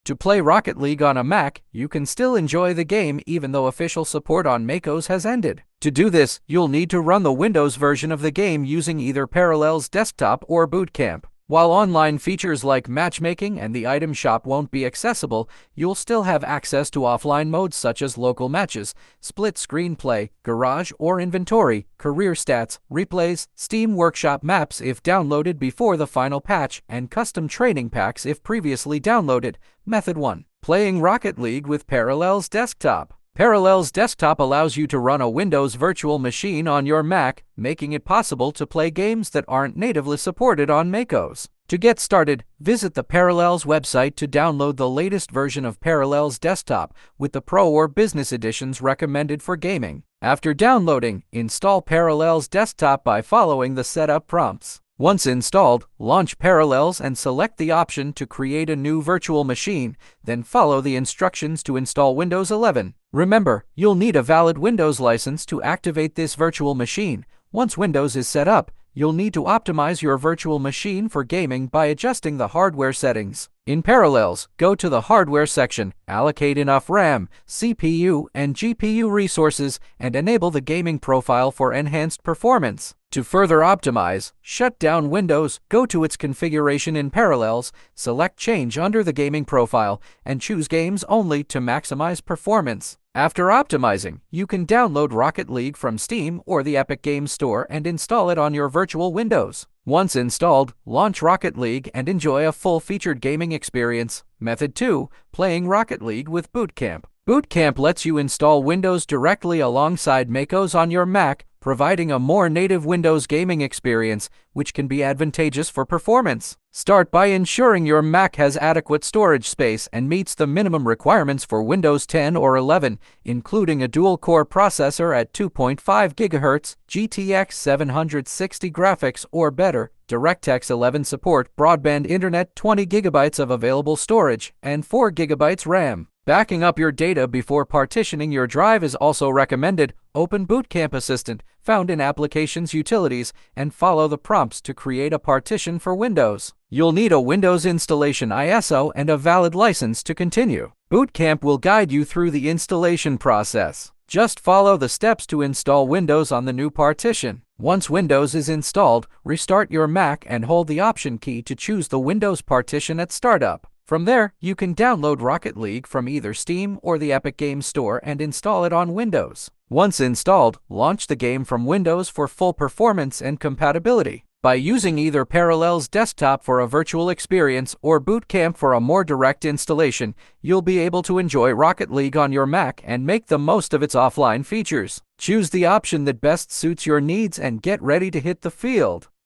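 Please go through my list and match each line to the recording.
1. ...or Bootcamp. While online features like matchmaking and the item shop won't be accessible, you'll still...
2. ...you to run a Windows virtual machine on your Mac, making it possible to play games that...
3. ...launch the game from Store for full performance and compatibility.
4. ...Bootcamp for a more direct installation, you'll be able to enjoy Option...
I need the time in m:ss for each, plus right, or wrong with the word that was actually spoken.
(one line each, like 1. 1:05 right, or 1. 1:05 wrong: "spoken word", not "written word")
1. 0:10 right
2. 0:34 right
3. 2:50 wrong: "Windows", not "Store"
4. 2:58 wrong: "Rocket", not "Option".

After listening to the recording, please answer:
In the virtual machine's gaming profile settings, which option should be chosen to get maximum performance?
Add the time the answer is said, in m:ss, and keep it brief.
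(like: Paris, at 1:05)
Games Only, at 1:30.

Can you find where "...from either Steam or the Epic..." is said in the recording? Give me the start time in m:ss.
2:45.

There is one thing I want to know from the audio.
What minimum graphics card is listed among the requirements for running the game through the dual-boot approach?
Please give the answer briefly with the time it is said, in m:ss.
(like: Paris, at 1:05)
GTX 760, at 2:06.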